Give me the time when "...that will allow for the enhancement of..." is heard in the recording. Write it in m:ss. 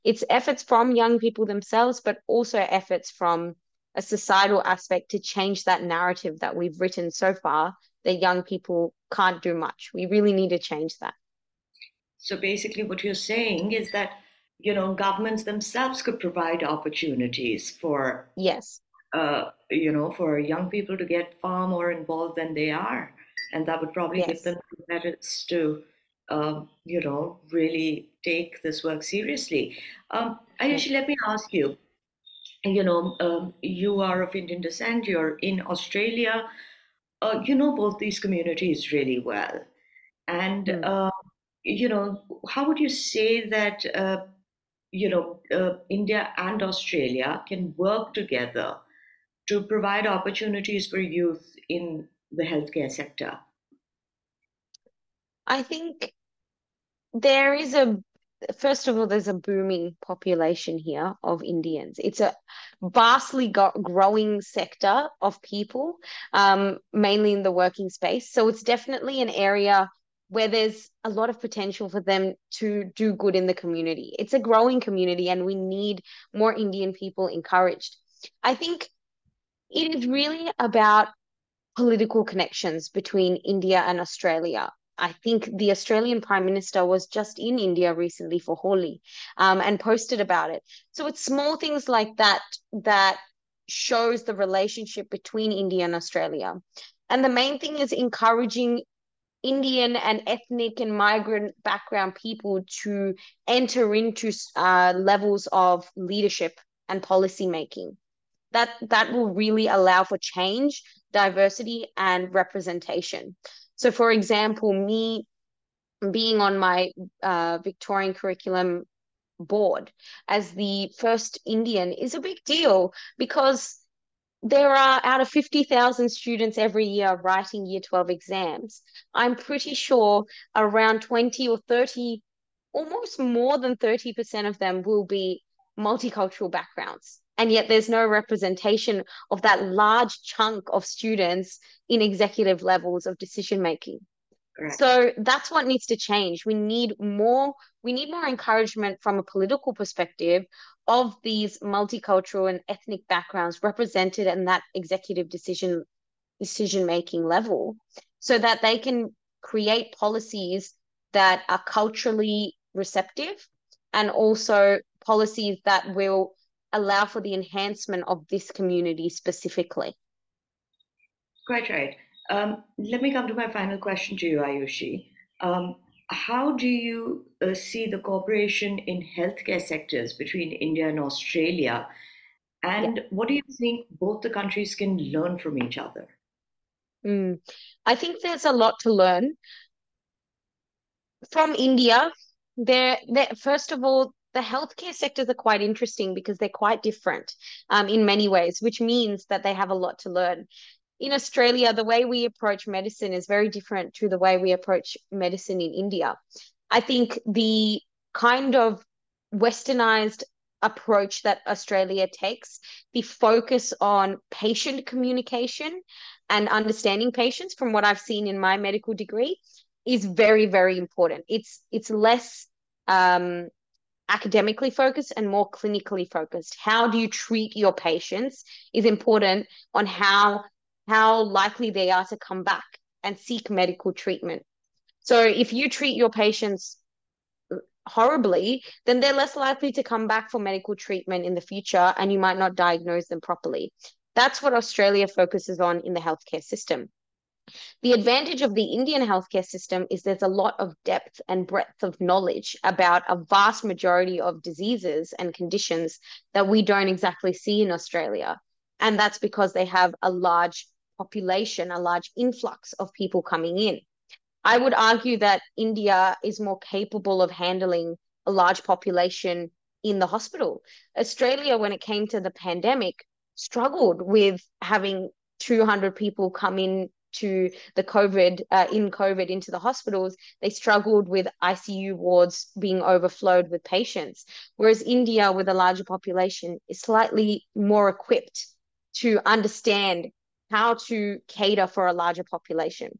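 2:45.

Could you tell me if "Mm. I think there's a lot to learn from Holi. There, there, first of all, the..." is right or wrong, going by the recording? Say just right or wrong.
wrong.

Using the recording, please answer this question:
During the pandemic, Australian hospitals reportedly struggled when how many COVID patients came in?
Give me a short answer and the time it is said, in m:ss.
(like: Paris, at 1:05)
200, at 4:35.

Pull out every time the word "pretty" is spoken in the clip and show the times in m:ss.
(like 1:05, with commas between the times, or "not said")
2:09.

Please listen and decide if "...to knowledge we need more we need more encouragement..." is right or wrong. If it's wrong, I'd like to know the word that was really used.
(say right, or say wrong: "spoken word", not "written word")
wrong: "change", not "knowledge".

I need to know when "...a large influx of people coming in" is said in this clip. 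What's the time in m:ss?
4:21.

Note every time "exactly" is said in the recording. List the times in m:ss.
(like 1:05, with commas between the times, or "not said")
4:16.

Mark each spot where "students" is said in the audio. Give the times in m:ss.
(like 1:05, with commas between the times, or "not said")
2:06, 2:20.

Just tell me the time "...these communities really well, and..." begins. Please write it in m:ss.
0:37.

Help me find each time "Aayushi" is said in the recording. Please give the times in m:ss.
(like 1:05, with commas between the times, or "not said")
0:30, 2:54.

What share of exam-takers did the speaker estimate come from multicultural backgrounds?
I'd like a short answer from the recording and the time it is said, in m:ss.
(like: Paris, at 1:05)
more than 30%, at 2:13.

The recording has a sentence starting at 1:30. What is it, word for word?
So it's small things like that that shows the relationship between India and Australia.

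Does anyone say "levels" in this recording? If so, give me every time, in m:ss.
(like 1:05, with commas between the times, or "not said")
1:44, 2:22, 2:37.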